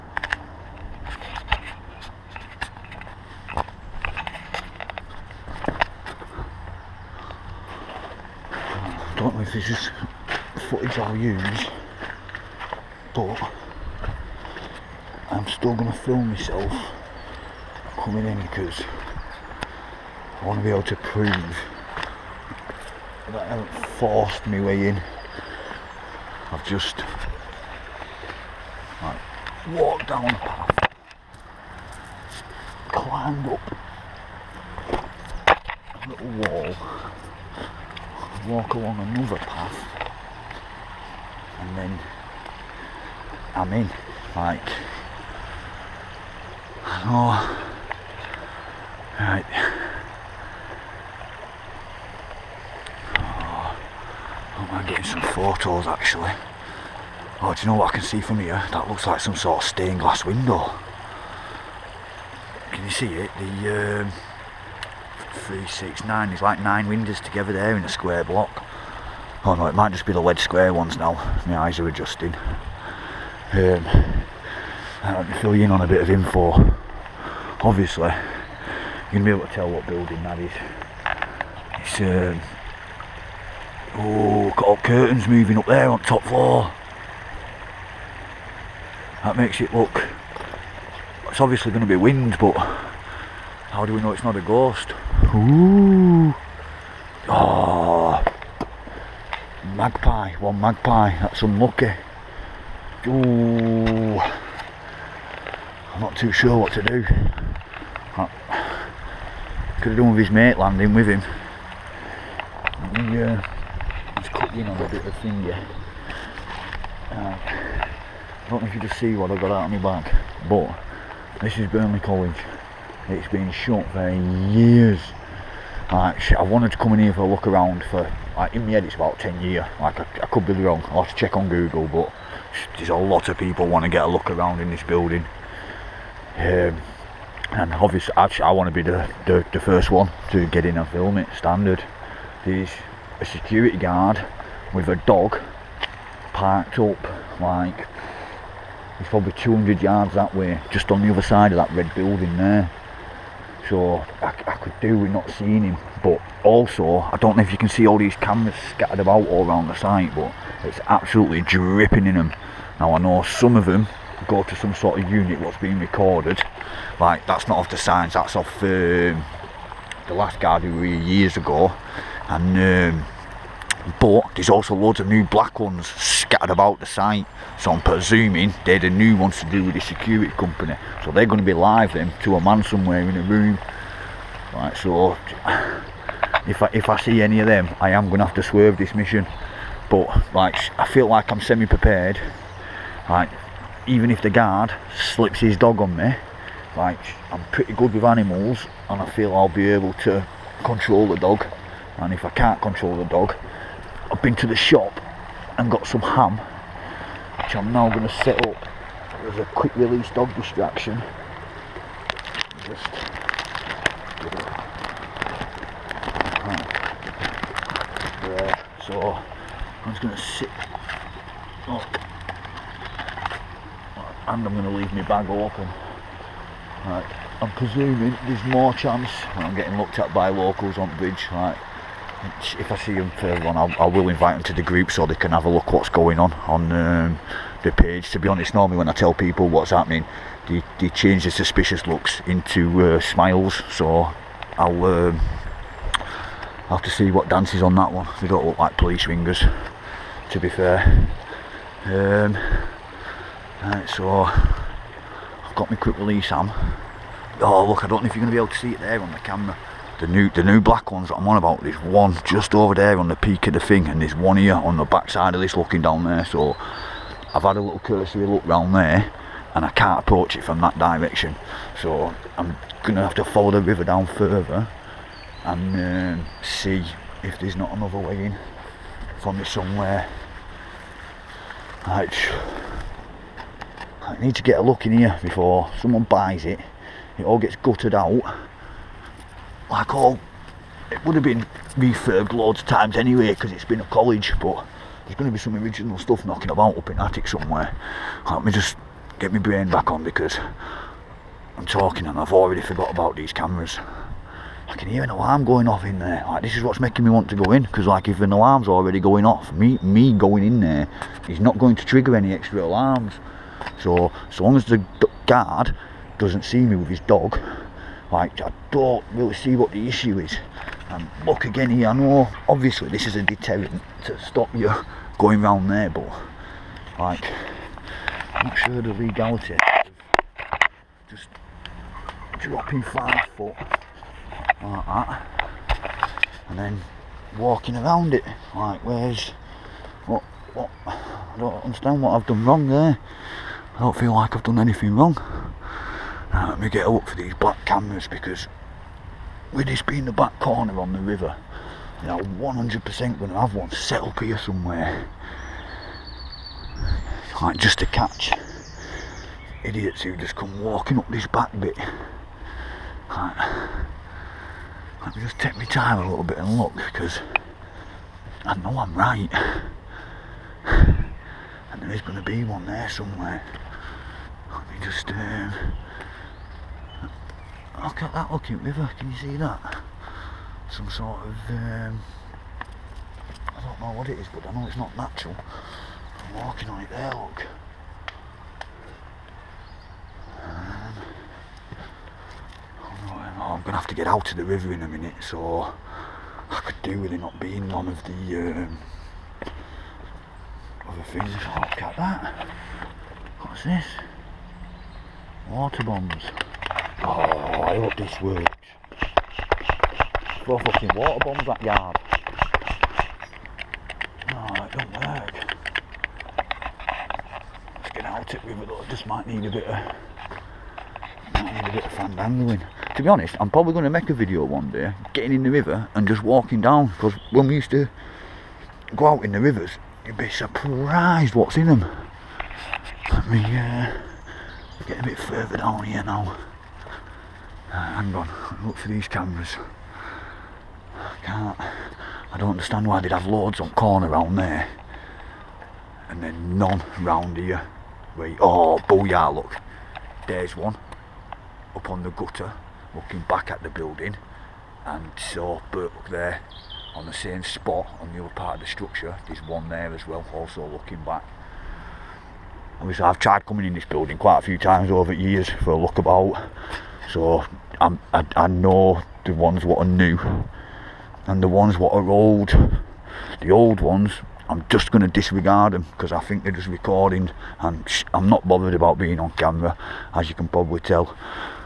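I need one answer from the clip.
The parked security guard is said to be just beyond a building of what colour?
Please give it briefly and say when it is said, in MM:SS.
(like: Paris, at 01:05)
red, at 02:31.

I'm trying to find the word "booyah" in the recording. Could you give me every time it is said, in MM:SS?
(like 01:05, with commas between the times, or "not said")
07:28.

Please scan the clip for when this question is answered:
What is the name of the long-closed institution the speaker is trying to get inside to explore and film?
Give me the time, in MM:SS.
02:01.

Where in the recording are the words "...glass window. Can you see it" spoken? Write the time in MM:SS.
00:59.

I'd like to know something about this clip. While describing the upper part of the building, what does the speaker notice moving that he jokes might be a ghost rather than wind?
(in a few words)
curtains.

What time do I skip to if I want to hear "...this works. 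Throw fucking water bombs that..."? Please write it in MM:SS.
06:47.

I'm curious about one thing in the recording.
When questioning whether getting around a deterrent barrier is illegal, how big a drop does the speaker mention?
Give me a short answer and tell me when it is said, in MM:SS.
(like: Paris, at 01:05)
five foot, at 05:32.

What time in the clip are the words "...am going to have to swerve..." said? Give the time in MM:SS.
03:07.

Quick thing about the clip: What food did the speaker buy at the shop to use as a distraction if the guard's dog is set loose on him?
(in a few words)
ham.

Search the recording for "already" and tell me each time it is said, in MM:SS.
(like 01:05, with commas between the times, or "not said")
05:02, 05:08.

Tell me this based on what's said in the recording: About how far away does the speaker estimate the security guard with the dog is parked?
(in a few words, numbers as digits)
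200 yards.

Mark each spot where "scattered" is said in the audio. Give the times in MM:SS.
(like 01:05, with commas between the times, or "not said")
02:38, 02:55.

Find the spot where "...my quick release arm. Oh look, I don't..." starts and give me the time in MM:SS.
04:15.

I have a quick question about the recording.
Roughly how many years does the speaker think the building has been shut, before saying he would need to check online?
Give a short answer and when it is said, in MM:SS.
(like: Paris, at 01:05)
10 years, at 02:09.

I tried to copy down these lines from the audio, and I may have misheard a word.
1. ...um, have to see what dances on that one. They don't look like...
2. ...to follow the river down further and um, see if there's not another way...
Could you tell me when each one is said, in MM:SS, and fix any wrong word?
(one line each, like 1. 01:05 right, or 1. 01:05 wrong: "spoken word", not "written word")
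1. 04:04 right
2. 04:33 right.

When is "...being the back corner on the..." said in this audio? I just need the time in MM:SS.
05:49.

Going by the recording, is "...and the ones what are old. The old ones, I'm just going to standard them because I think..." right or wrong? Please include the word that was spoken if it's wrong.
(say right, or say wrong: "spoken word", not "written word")
wrong: "disregard", not "standard".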